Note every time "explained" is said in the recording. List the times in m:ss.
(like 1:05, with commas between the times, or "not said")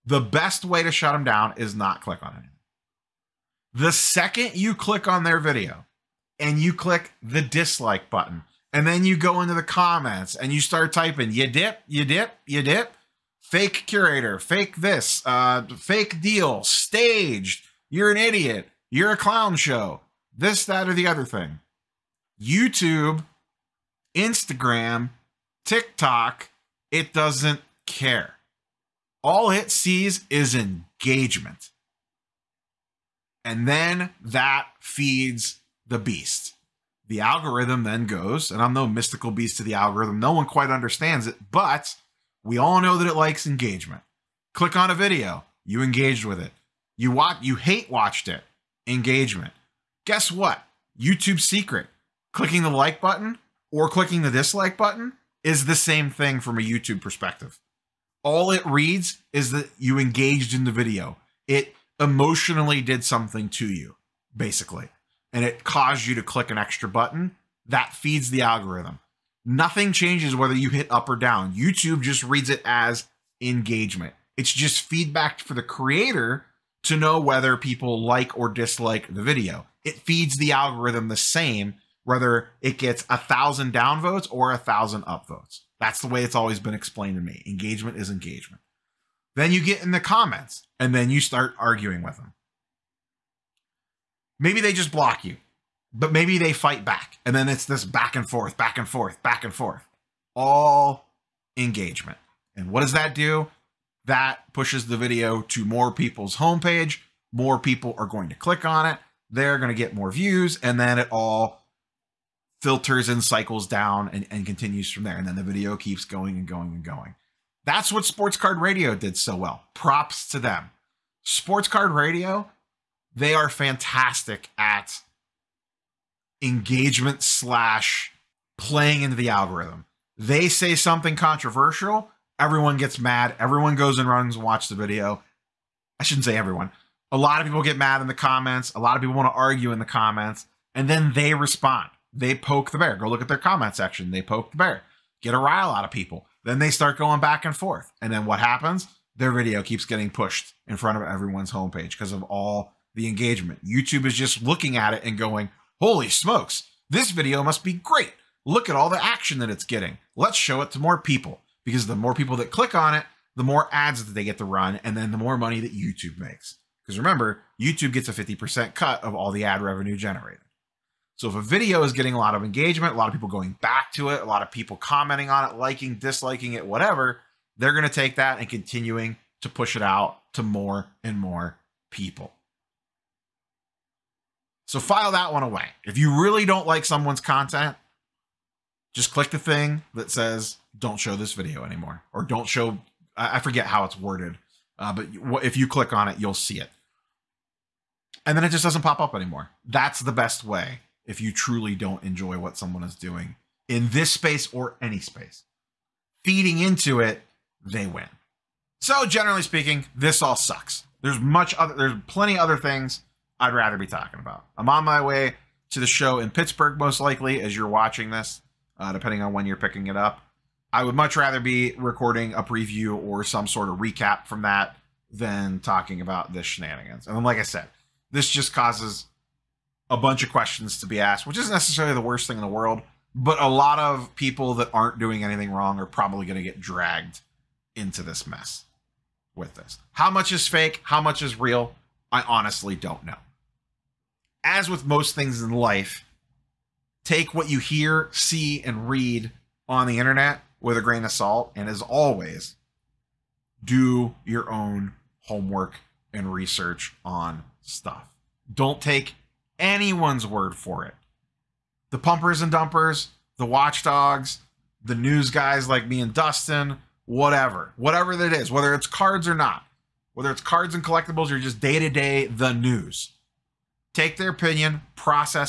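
1:26.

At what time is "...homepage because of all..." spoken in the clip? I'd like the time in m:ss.
2:31.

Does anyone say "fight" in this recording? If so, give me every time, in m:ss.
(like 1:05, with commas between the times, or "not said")
1:36.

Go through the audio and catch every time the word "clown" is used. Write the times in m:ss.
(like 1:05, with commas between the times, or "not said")
0:19.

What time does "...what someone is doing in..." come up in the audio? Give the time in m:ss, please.
3:22.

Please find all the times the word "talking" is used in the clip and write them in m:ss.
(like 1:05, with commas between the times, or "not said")
3:33, 3:45.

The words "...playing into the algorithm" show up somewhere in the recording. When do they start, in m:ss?
2:08.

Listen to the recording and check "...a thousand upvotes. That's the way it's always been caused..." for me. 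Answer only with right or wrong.
wrong.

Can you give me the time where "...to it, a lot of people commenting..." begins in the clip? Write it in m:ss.
2:53.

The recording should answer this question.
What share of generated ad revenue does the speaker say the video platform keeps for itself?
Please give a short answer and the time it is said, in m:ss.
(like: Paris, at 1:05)
50%, at 2:48.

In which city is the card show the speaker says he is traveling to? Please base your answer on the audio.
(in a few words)
Pittsburgh.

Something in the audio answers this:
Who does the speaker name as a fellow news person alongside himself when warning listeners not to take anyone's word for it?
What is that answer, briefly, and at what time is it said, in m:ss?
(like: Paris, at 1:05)
Dustin, at 4:26.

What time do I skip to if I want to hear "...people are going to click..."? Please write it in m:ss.
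1:47.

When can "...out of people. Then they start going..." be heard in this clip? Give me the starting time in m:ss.
2:25.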